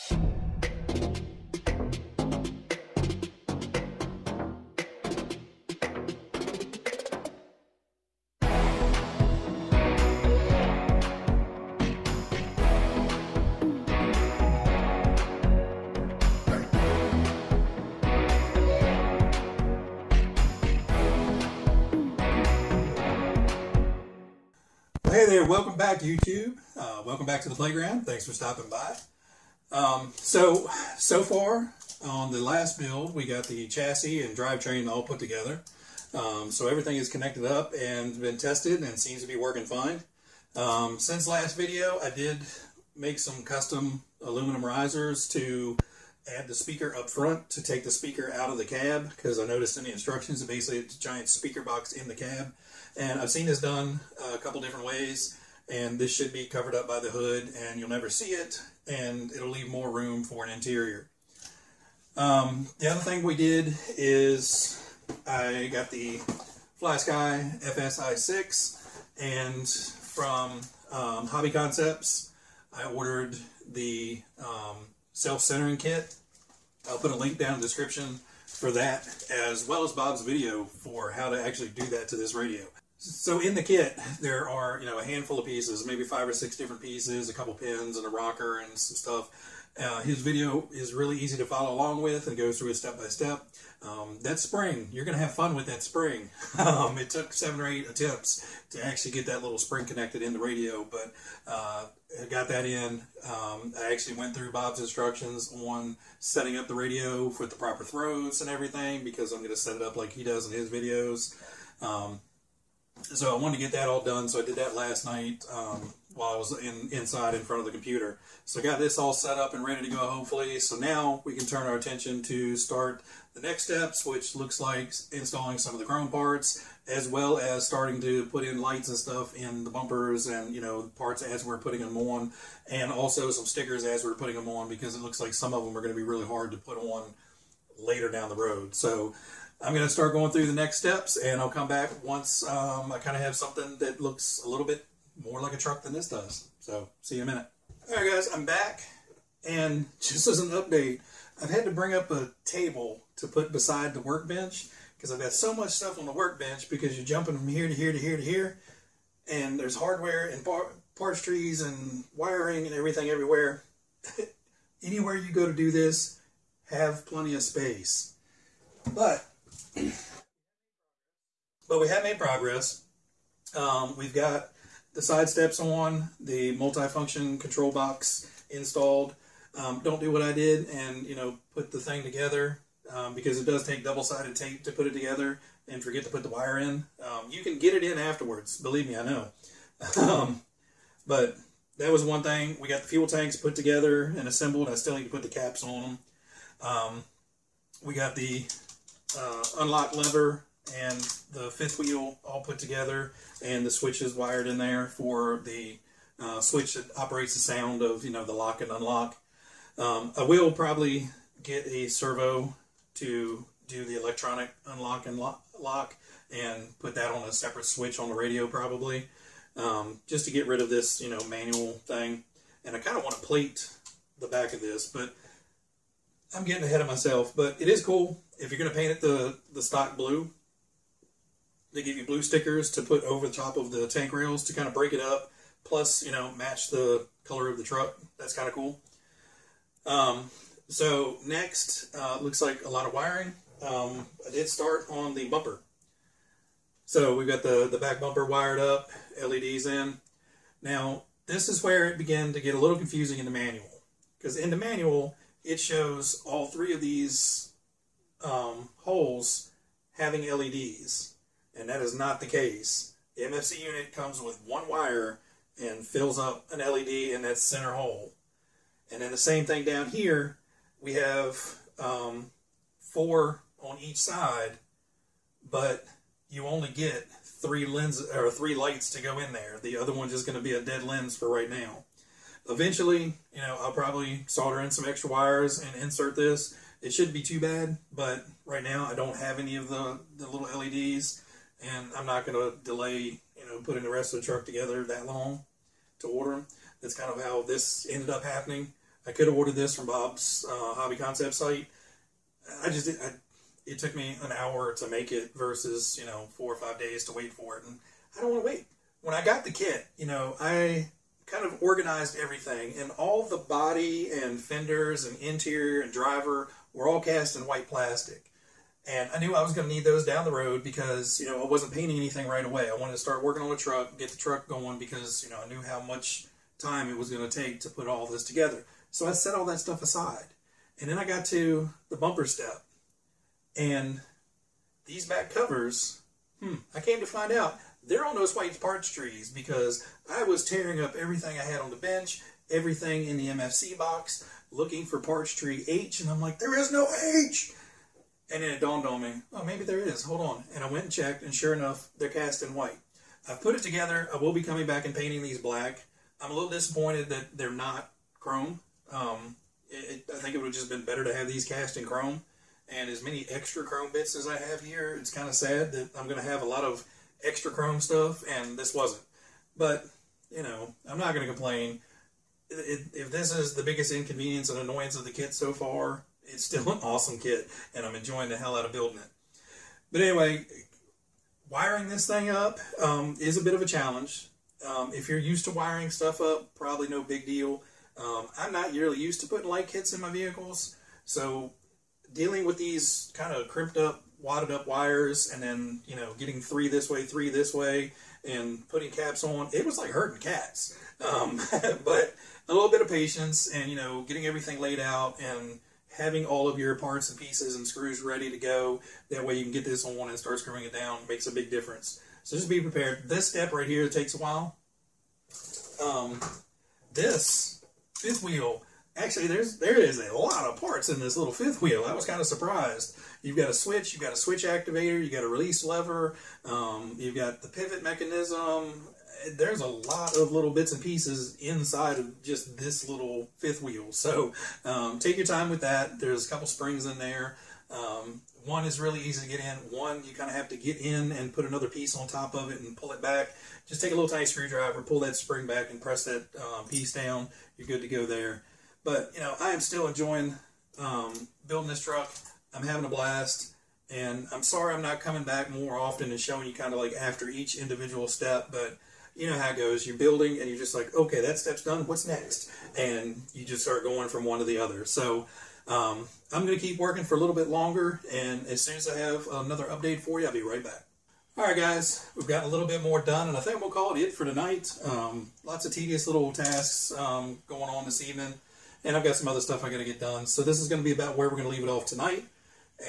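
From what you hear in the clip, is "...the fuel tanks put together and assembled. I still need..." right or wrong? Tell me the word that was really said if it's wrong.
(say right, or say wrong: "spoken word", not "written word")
right.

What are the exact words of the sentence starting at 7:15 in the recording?
There's a couple springs in there.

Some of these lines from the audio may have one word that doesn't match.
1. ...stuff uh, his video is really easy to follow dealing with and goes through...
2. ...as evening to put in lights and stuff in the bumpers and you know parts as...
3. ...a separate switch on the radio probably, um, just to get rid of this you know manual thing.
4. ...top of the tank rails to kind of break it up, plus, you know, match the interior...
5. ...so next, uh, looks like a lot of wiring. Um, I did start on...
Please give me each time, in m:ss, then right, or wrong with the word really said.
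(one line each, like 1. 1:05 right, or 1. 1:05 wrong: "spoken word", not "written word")
1. 1:28 wrong: "along", not "dealing"
2. 2:07 wrong: "starting", not "evening"
3. 3:37 right
4. 3:53 wrong: "color", not "interior"
5. 4:00 right.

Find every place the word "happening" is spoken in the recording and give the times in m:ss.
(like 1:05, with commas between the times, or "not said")
4:58.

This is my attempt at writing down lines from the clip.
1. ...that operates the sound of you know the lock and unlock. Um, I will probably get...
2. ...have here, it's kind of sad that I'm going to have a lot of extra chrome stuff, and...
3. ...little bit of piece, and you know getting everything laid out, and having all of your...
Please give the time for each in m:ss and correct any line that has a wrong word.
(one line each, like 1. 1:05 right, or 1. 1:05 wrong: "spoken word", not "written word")
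1. 3:26 right
2. 6:04 right
3. 6:42 wrong: "patience", not "piece".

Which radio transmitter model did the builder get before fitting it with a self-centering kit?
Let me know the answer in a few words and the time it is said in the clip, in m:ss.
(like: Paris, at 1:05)
Fly Sky FS-I6, at 1:06.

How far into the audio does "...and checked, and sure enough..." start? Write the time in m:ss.
5:50.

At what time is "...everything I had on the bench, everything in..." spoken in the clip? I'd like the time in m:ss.
5:40.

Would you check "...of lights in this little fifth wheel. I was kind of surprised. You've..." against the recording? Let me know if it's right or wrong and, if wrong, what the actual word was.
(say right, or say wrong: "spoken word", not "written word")
wrong: "parts", not "lights".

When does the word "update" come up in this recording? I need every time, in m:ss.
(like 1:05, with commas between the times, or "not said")
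2:30, 7:49.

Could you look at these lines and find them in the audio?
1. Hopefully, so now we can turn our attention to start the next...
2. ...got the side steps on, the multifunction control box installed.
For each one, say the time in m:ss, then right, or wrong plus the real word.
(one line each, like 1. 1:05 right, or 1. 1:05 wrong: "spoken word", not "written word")
1. 1:59 right
2. 2:54 right.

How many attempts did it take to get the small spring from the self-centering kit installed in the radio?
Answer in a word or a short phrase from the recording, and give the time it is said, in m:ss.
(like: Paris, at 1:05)
7 or 8, at 1:37.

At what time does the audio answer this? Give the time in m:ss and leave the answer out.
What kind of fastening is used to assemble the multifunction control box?
3:03.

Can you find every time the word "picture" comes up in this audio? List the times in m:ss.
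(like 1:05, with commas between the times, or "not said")
not said.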